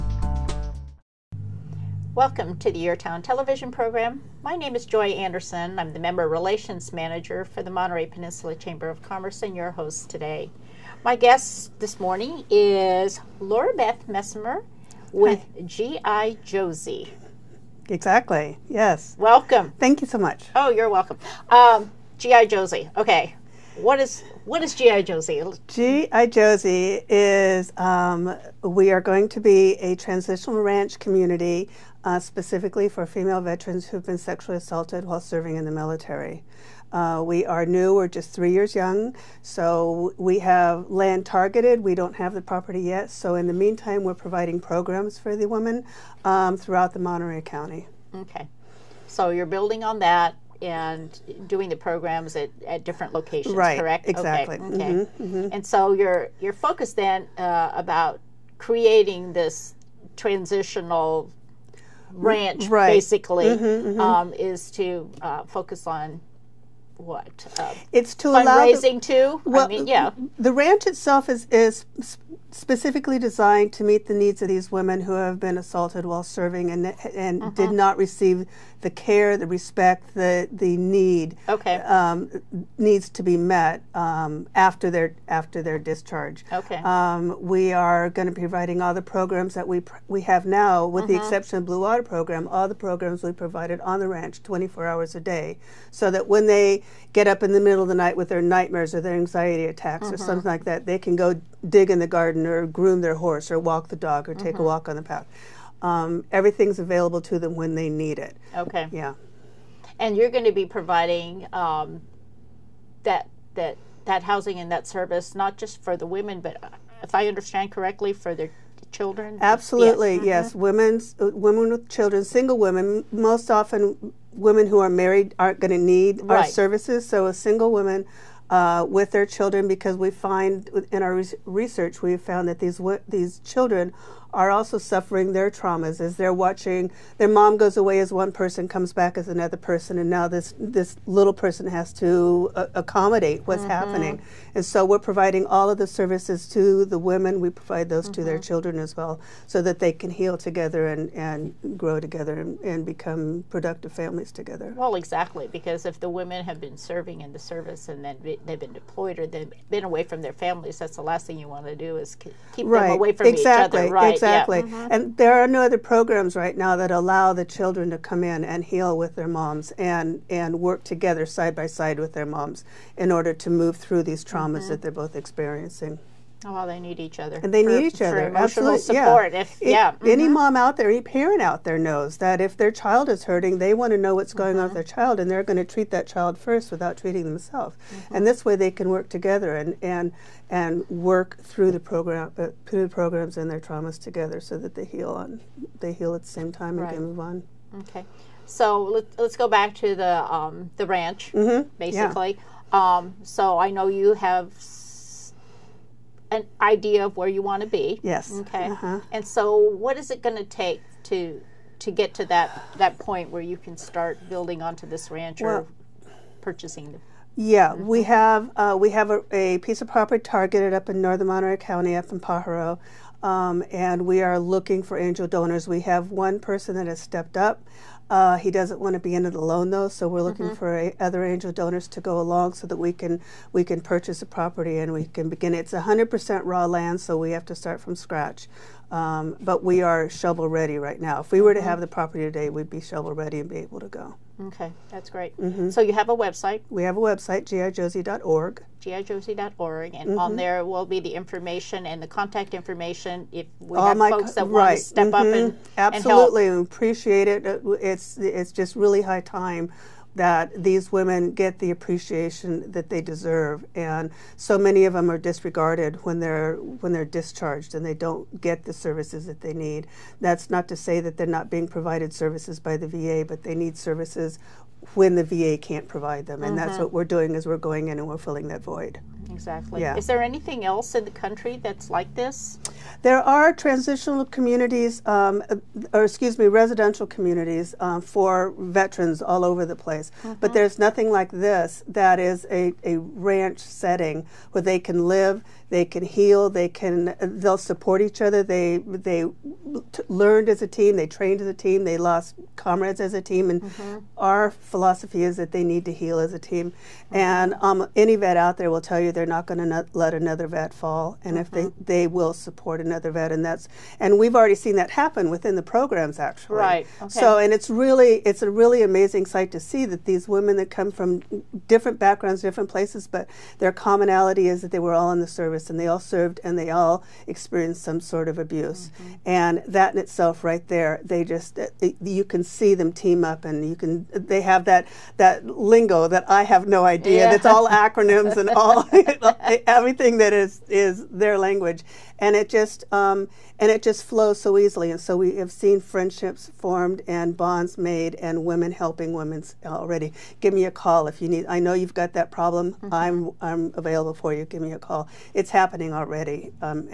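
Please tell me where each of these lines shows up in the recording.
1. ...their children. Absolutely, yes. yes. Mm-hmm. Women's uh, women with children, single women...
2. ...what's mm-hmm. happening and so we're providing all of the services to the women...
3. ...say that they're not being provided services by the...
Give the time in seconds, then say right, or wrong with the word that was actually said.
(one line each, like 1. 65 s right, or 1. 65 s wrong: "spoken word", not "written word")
1. 118 s right
2. 143 s right
3. 270 s right.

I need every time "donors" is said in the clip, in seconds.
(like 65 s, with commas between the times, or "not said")
225 s, 231 s.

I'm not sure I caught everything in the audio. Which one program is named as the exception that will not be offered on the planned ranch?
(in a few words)
Blue Water Program.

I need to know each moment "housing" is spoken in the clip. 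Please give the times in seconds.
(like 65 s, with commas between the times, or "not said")
114 s.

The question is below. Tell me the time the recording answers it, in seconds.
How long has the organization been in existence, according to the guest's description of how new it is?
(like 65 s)
38 s.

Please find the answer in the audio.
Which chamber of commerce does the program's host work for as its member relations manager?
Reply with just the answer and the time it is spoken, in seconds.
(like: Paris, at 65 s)
Monterey Peninsula Chamber of Commerce, at 7 s.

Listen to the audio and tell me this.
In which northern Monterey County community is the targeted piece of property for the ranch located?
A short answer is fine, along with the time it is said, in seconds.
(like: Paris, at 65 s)
Pajaro, at 222 s.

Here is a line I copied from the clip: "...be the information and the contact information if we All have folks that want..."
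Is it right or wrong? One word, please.
right.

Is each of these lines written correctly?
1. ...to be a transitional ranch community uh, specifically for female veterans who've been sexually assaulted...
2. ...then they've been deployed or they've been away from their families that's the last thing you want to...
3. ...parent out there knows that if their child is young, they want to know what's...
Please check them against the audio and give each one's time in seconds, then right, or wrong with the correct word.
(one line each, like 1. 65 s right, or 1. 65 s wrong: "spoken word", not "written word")
1. 29 s right
2. 158 s right
3. 181 s wrong: "hurting", not "young".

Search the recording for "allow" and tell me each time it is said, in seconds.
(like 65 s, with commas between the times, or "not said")
68 s, 166 s.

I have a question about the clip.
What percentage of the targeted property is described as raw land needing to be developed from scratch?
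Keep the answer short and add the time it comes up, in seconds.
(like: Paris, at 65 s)
100%, at 235 s.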